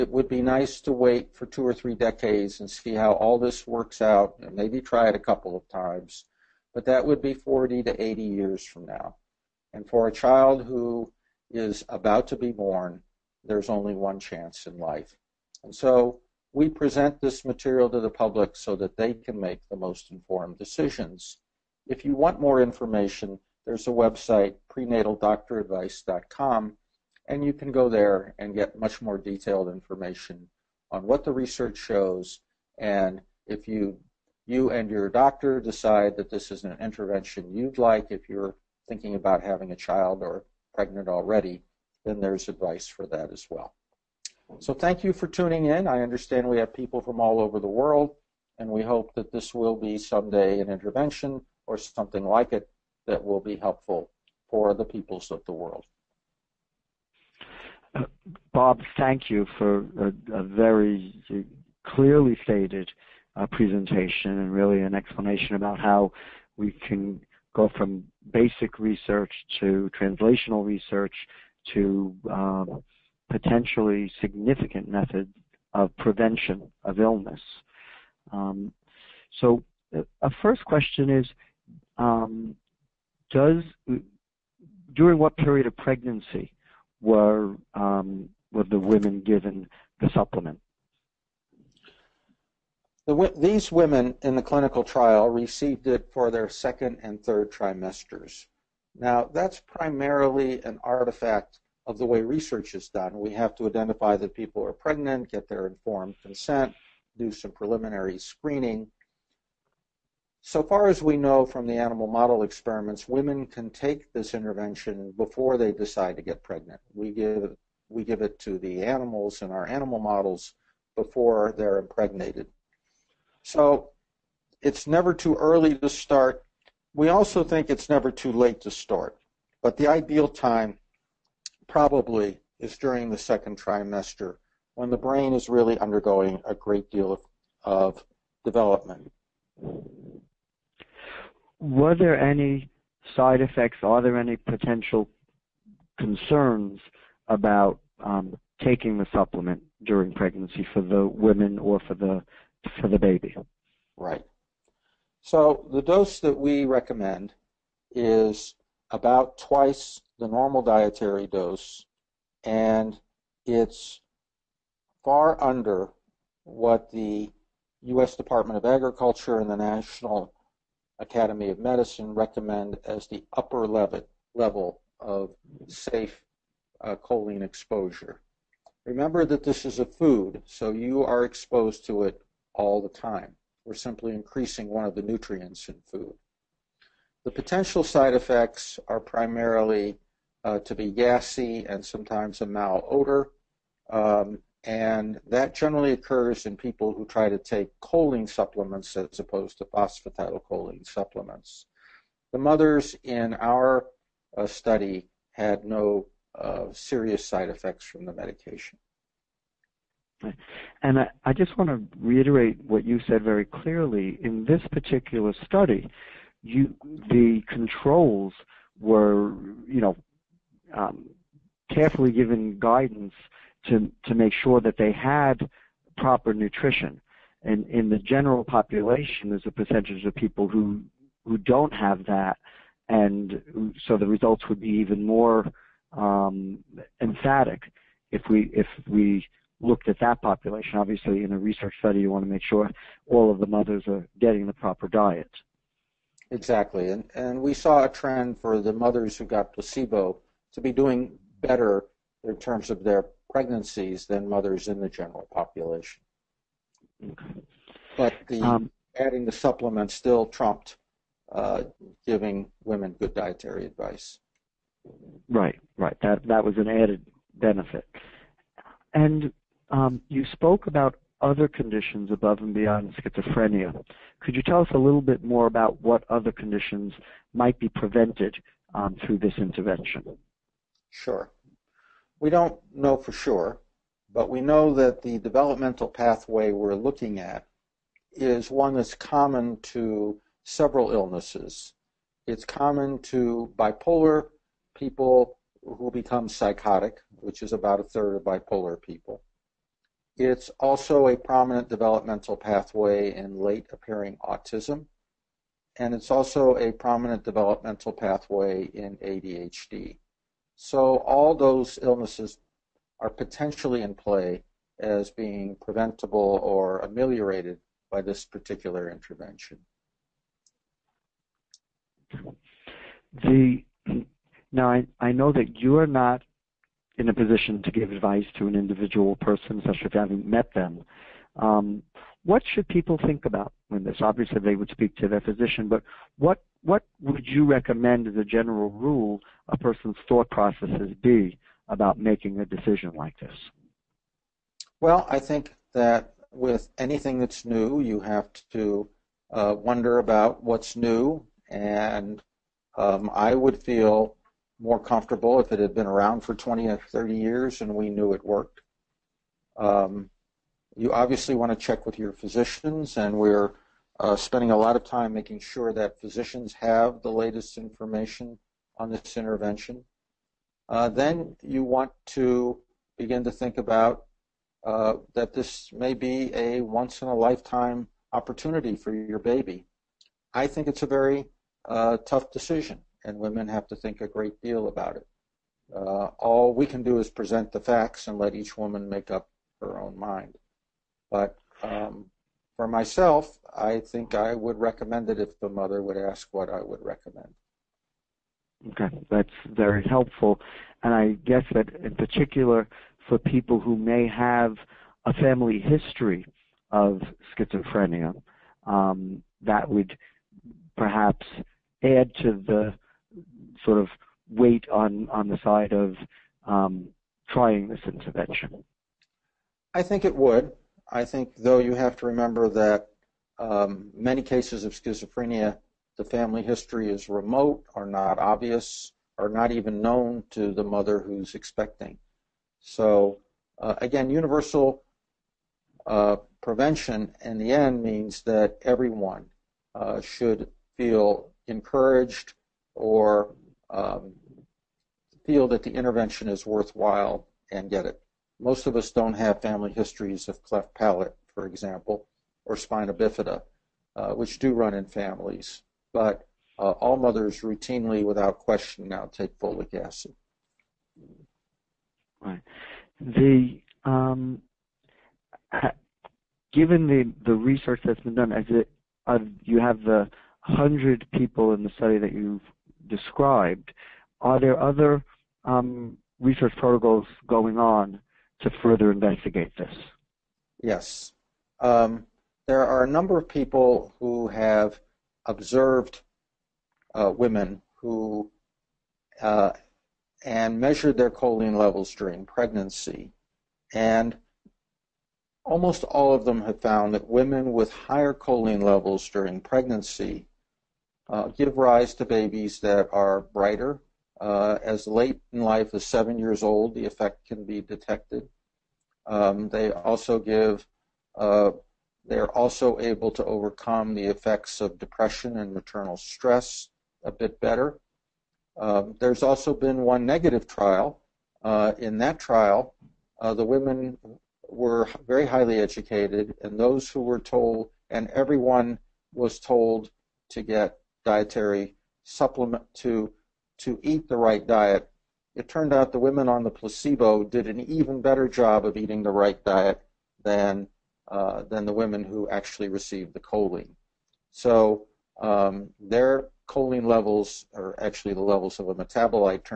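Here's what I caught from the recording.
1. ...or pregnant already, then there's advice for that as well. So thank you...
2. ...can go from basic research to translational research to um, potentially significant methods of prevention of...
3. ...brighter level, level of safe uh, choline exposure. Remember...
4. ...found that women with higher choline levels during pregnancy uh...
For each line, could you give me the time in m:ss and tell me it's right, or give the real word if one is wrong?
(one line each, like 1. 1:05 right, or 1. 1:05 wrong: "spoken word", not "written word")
1. 0:40 right
2. 1:06 right
3. 2:53 wrong: "upper", not "brighter"
4. 8:16 right.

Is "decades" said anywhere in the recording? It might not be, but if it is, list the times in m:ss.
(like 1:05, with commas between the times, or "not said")
0:01.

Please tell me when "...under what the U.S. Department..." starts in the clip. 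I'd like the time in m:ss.
2:45.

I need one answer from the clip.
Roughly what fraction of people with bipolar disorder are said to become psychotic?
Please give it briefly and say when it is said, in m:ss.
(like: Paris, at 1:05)
a third, at 4:57.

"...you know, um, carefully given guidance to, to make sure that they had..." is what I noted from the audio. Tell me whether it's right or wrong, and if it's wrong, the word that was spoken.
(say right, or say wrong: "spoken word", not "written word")
right.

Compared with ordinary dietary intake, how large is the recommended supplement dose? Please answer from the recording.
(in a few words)
twice the normal dietary dose.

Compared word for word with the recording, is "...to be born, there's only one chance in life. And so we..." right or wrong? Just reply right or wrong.
right.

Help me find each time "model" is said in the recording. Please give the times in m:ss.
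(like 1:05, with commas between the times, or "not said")
1:52, 1:59.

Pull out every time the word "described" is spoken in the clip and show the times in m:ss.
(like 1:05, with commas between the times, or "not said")
7:52.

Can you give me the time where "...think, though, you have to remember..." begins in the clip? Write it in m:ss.
7:01.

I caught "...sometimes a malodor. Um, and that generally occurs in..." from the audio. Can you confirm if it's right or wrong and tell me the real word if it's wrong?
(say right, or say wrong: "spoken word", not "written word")
right.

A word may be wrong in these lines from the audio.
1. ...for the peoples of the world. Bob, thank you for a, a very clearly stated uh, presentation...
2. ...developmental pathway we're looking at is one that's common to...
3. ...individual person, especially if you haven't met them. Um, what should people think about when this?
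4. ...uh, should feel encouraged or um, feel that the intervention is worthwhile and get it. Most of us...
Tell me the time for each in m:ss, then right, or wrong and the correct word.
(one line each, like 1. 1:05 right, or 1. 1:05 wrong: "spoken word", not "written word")
1. 0:54 right
2. 4:45 right
3. 5:28 right
4. 7:19 right.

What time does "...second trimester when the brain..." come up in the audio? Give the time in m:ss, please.
2:13.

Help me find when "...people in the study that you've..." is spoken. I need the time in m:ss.
7:51.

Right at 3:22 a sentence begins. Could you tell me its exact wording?
The mothers in our uh, study had no uh, serious side effects from the medication.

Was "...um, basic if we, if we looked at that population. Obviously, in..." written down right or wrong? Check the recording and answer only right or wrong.
wrong.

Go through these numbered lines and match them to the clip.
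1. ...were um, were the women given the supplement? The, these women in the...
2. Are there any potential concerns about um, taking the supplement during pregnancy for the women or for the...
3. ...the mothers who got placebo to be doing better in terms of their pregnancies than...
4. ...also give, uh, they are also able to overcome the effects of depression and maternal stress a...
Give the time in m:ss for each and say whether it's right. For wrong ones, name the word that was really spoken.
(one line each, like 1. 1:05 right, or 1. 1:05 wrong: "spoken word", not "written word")
1. 1:27 right
2. 2:23 right
3. 4:08 right
4. 8:29 right.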